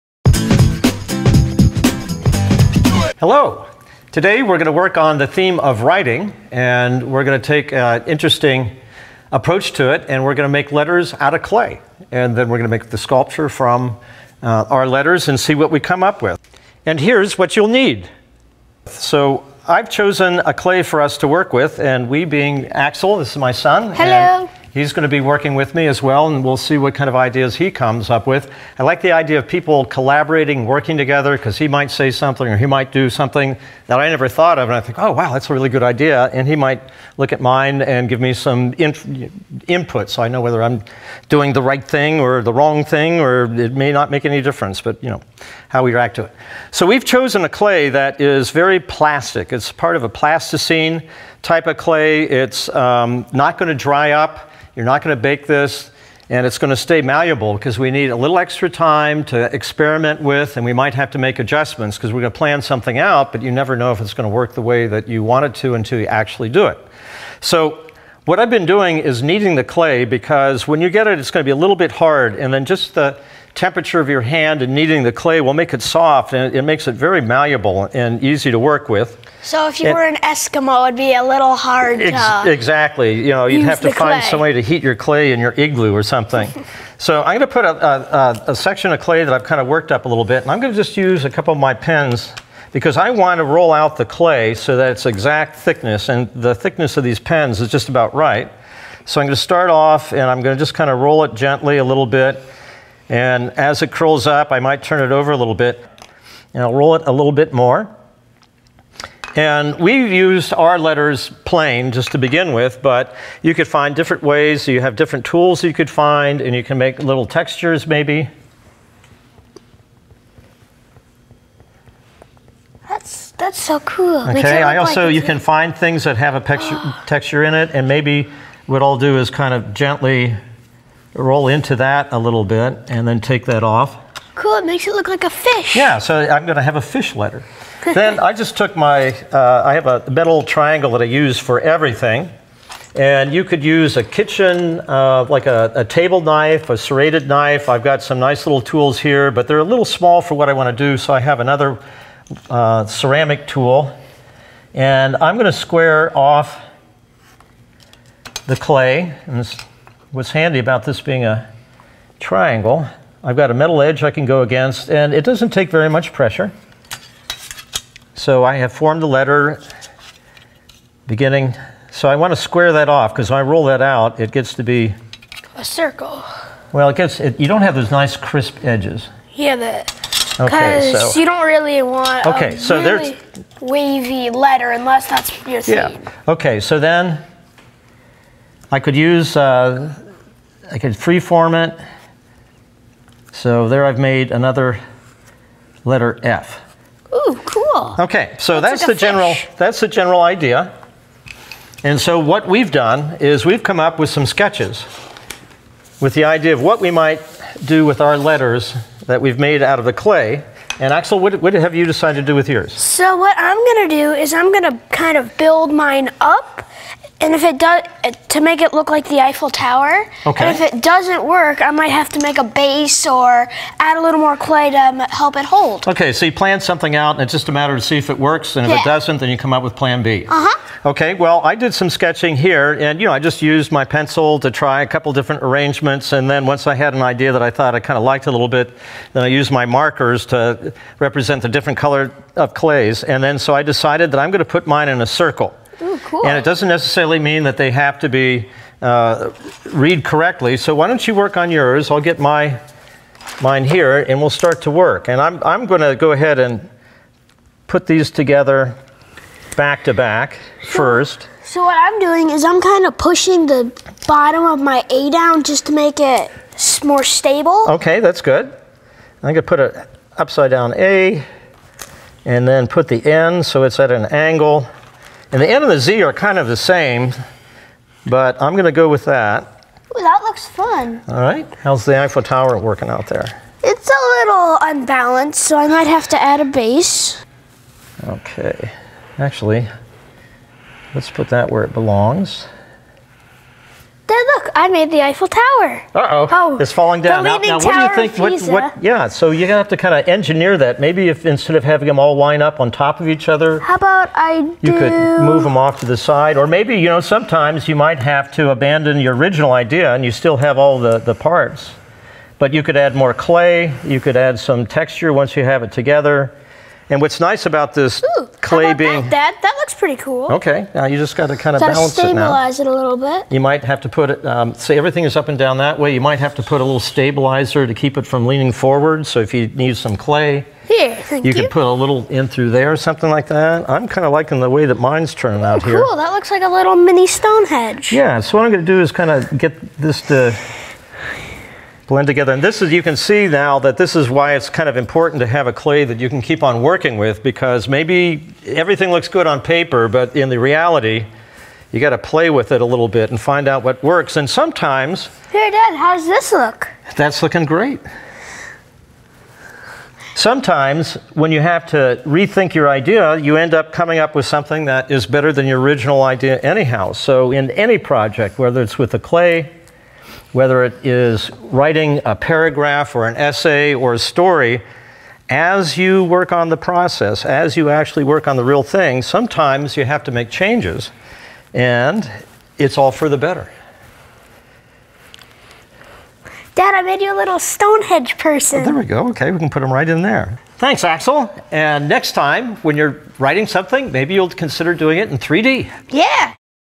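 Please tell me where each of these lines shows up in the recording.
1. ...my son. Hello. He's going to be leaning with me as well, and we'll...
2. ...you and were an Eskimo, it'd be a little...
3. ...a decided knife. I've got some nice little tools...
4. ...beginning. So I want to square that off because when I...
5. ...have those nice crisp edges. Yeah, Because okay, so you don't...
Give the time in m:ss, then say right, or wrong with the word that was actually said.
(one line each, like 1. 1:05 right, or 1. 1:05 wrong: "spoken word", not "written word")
1. 0:23 wrong: "working", not "leaning"
2. 1:19 right
3. 2:26 wrong: "serrated", not "decided"
4. 2:51 right
5. 2:57 right.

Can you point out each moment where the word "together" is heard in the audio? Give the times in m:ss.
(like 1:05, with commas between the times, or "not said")
0:30, 4:18, 5:15, 5:42.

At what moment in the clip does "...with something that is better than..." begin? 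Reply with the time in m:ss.
6:04.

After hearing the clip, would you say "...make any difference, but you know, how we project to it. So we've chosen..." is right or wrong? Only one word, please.
wrong.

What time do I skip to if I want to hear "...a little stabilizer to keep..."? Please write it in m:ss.
5:26.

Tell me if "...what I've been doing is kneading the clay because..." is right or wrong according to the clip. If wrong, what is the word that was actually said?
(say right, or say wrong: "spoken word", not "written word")
right.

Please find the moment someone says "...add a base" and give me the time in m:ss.
4:46.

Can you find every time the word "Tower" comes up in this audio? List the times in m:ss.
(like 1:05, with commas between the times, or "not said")
3:39, 4:42, 4:55.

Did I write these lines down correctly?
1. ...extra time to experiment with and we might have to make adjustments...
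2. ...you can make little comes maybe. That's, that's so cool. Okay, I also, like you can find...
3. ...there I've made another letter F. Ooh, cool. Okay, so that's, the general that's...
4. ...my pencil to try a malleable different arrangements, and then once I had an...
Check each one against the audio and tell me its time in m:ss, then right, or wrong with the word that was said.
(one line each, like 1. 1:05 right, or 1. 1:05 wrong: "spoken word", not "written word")
1. 0:58 right
2. 1:56 wrong: "textures", not "comes"
3. 3:13 right
4. 3:53 wrong: "couple", not "malleable".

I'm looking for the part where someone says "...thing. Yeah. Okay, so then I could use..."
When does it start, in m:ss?
3:05.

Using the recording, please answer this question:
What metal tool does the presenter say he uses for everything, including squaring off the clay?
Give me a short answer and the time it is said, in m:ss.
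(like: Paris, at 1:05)
a metal triangle, at 2:20.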